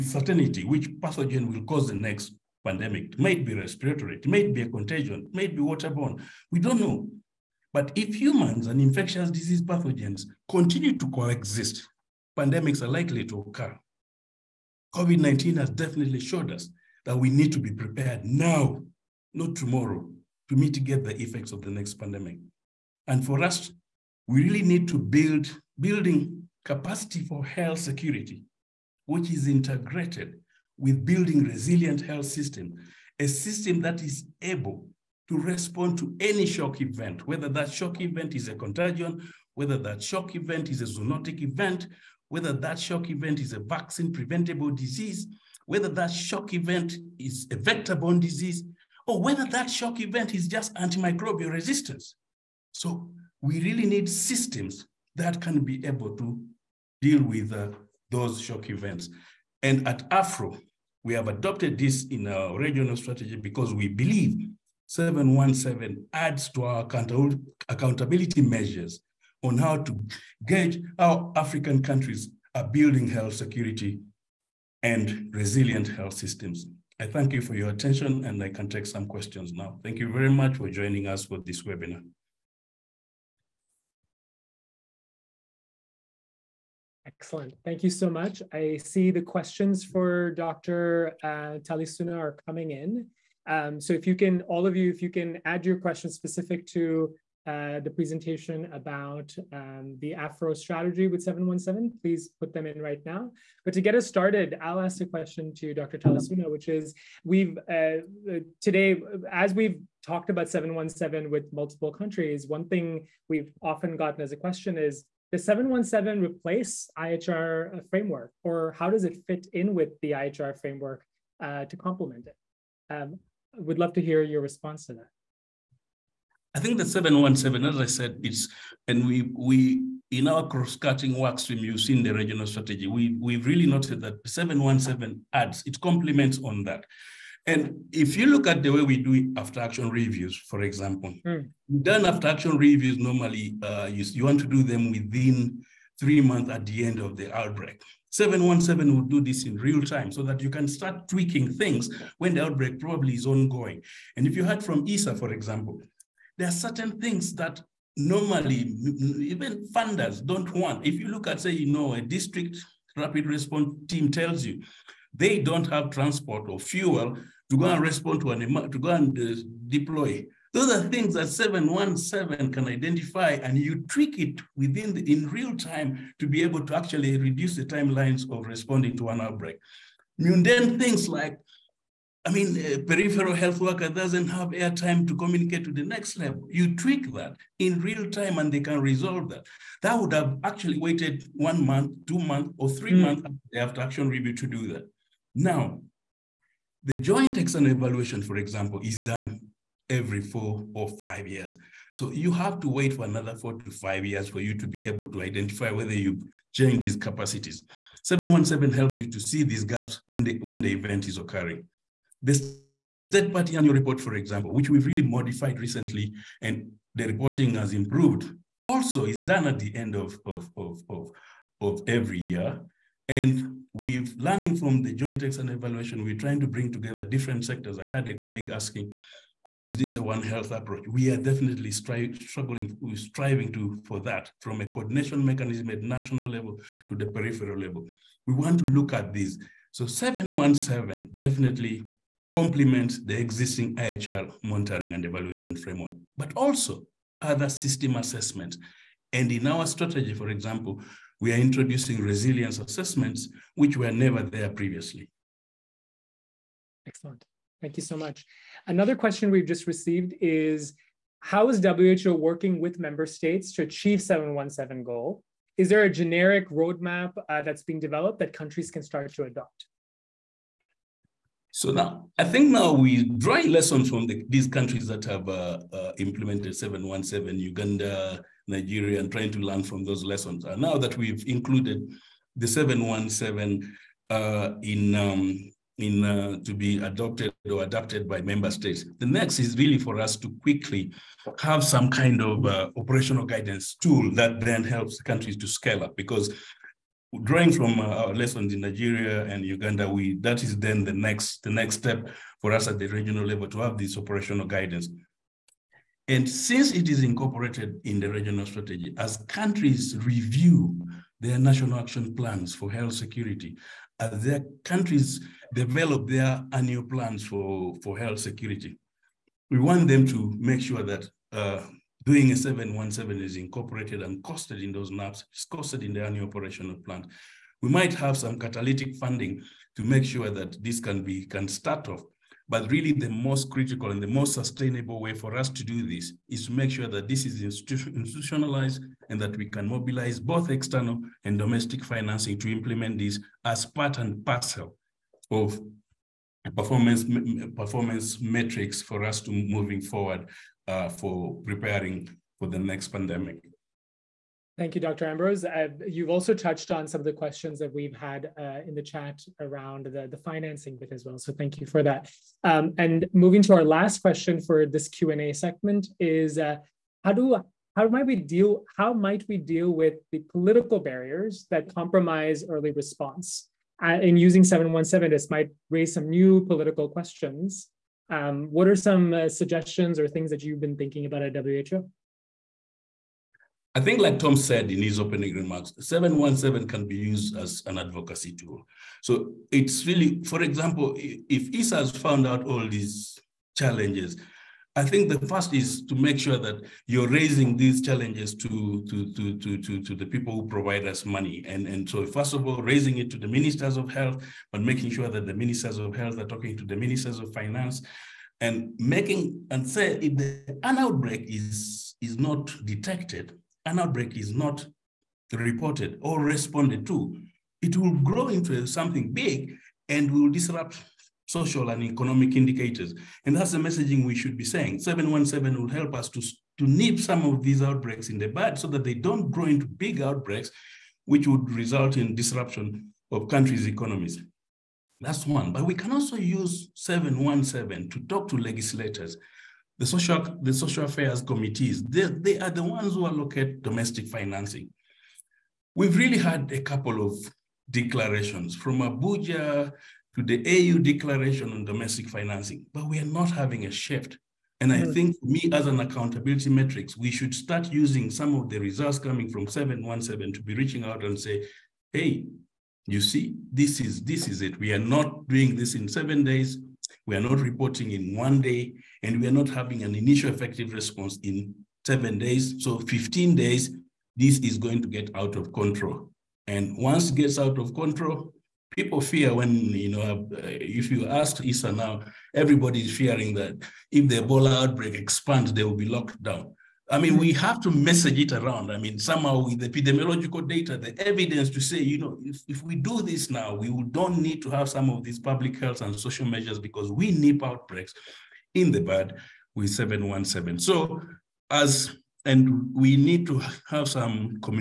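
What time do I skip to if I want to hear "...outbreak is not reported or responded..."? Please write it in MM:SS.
06:53.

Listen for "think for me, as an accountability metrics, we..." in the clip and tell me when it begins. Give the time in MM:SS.
07:34.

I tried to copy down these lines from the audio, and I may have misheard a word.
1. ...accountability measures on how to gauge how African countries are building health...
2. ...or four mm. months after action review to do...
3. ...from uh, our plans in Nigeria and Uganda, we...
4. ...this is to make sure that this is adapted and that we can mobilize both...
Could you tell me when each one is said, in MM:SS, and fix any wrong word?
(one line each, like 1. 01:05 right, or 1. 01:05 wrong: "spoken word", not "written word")
1. 01:07 right
2. 03:12 wrong: "three", not "four"
3. 04:57 wrong: "lessons", not "plans"
4. 05:35 wrong: "institutionalized", not "adapted".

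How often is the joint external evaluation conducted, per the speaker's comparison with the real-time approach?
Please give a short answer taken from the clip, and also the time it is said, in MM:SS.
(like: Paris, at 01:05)
every 4 or 5 years, at 03:19.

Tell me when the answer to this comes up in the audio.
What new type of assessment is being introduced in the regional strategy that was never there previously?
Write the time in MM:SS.
04:12.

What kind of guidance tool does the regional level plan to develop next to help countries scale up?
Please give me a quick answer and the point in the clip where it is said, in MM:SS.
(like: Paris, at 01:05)
operational guidance tool, at 04:52.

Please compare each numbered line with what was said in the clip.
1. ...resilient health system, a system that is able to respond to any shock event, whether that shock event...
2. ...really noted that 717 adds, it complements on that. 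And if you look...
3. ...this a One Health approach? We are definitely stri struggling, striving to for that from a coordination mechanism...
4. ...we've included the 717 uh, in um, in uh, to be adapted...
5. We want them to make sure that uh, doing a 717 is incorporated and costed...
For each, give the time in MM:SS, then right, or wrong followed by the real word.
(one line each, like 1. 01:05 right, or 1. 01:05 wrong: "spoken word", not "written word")
1. 00:31 right
2. 02:13 right
3. 03:49 right
4. 04:40 wrong: "adopted", not "adapted"
5. 05:19 right.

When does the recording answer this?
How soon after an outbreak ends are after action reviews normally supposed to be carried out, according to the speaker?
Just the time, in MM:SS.
02:24.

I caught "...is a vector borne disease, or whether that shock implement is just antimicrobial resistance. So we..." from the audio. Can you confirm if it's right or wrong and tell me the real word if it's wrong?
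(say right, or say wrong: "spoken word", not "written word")
wrong: "event", not "implement".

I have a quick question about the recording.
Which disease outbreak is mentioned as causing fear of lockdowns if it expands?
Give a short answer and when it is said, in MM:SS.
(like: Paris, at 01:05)
Ebola, at 08:04.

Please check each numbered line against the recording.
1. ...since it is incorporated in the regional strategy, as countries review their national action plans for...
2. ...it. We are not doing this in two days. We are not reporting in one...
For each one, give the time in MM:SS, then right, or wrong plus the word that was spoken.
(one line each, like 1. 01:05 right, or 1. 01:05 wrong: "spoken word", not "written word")
1. 05:06 right
2. 07:44 wrong: "seven", not "two".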